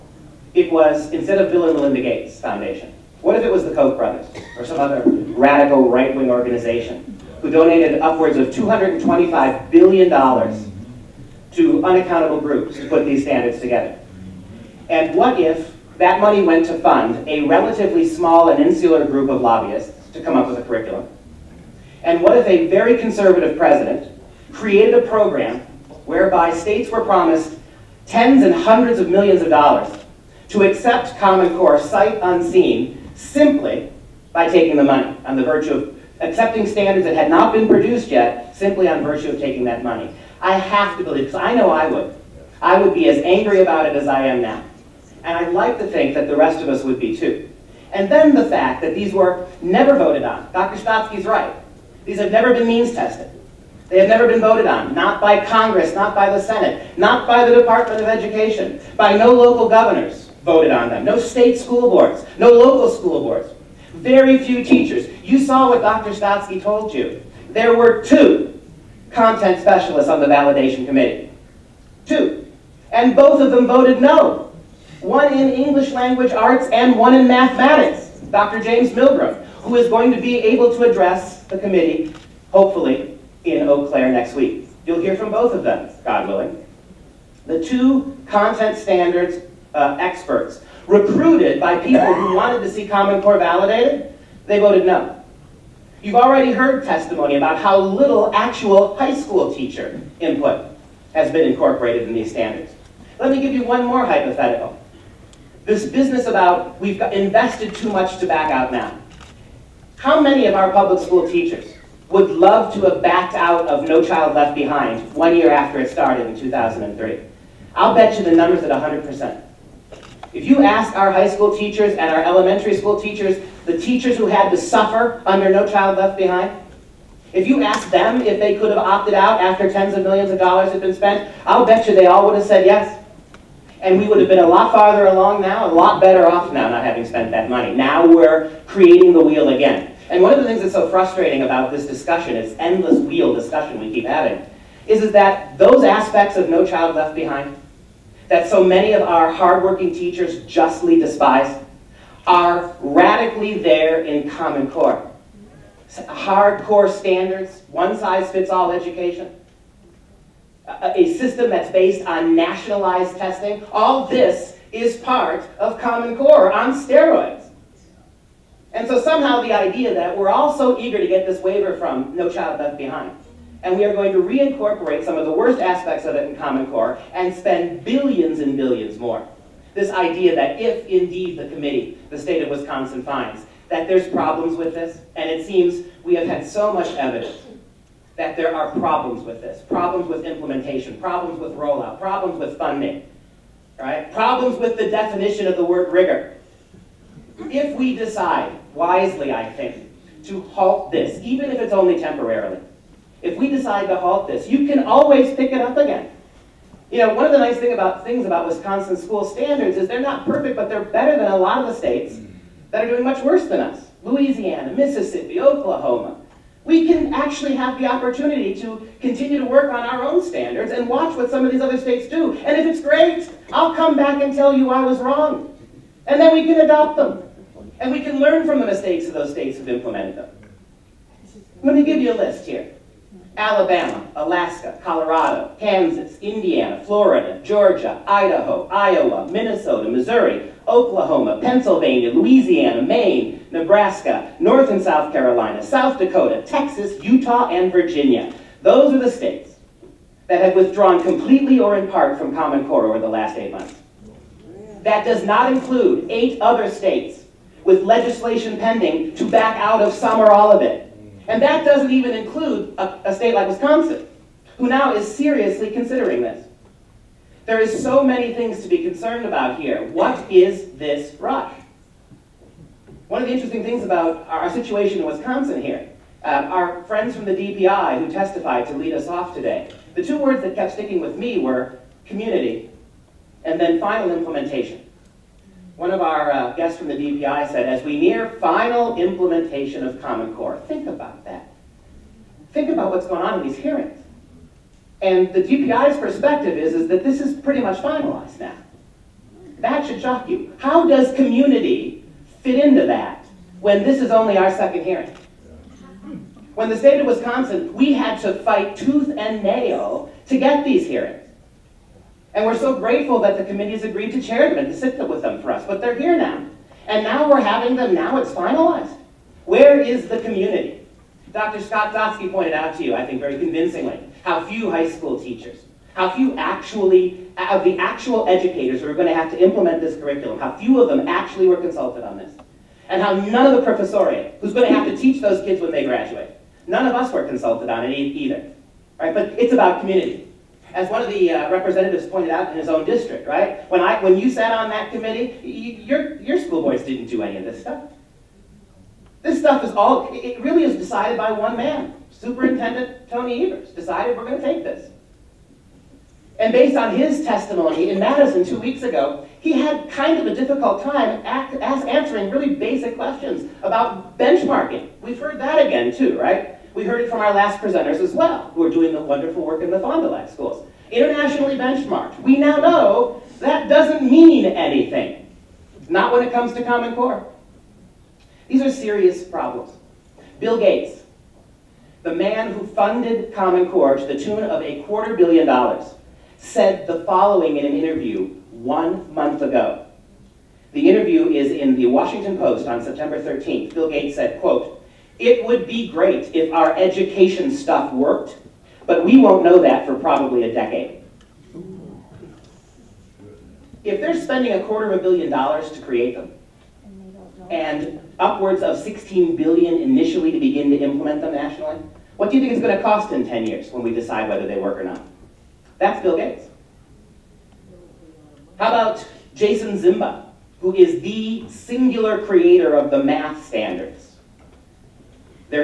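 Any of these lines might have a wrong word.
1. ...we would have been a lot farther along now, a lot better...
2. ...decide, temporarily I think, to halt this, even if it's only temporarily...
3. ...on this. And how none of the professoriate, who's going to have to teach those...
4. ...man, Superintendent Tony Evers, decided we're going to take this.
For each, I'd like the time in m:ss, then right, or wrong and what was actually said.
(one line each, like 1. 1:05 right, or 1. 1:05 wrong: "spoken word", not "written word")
1. 2:13 right
2. 3:17 wrong: "wisely", not "temporarily"
3. 5:32 right
4. 5:51 right.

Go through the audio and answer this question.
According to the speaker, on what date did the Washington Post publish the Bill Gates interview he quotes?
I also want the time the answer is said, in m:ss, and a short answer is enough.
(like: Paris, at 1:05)
September 13th, at 6:32.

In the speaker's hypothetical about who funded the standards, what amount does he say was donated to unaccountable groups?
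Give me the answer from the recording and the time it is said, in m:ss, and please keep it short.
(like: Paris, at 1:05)
$225 billion, at 0:08.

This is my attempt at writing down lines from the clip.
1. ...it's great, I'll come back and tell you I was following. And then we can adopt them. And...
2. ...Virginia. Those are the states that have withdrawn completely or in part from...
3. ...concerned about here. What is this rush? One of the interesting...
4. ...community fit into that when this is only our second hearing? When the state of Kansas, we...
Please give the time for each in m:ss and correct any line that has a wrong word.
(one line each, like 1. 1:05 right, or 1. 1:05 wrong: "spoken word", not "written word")
1. 3:42 wrong: "wrong", not "following"
2. 4:07 right
3. 4:28 right
4. 5:01 wrong: "Wisconsin", not "Kansas".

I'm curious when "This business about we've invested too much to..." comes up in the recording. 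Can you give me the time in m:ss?
1:45.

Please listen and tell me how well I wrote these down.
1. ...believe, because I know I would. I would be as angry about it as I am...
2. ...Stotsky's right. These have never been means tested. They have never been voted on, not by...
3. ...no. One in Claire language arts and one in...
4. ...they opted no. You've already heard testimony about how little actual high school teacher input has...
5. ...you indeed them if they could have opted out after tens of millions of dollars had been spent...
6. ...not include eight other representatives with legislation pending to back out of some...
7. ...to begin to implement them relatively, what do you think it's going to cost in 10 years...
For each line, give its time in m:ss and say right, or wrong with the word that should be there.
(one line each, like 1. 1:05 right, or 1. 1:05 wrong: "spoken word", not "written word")
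1. 0:41 right
2. 0:50 right
3. 1:13 wrong: "English", not "Claire"
4. 1:34 wrong: "voted", not "opted"
5. 2:07 wrong: "asked", not "indeed"
6. 4:15 wrong: "states", not "representatives"
7. 6:50 wrong: "nationally", not "relatively".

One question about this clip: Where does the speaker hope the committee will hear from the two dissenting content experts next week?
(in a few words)
Eau Claire.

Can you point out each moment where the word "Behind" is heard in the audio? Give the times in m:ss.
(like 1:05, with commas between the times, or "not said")
1:54, 2:06, 2:27, 2:52.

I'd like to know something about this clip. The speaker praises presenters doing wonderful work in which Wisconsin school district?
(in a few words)
Fond du Lac.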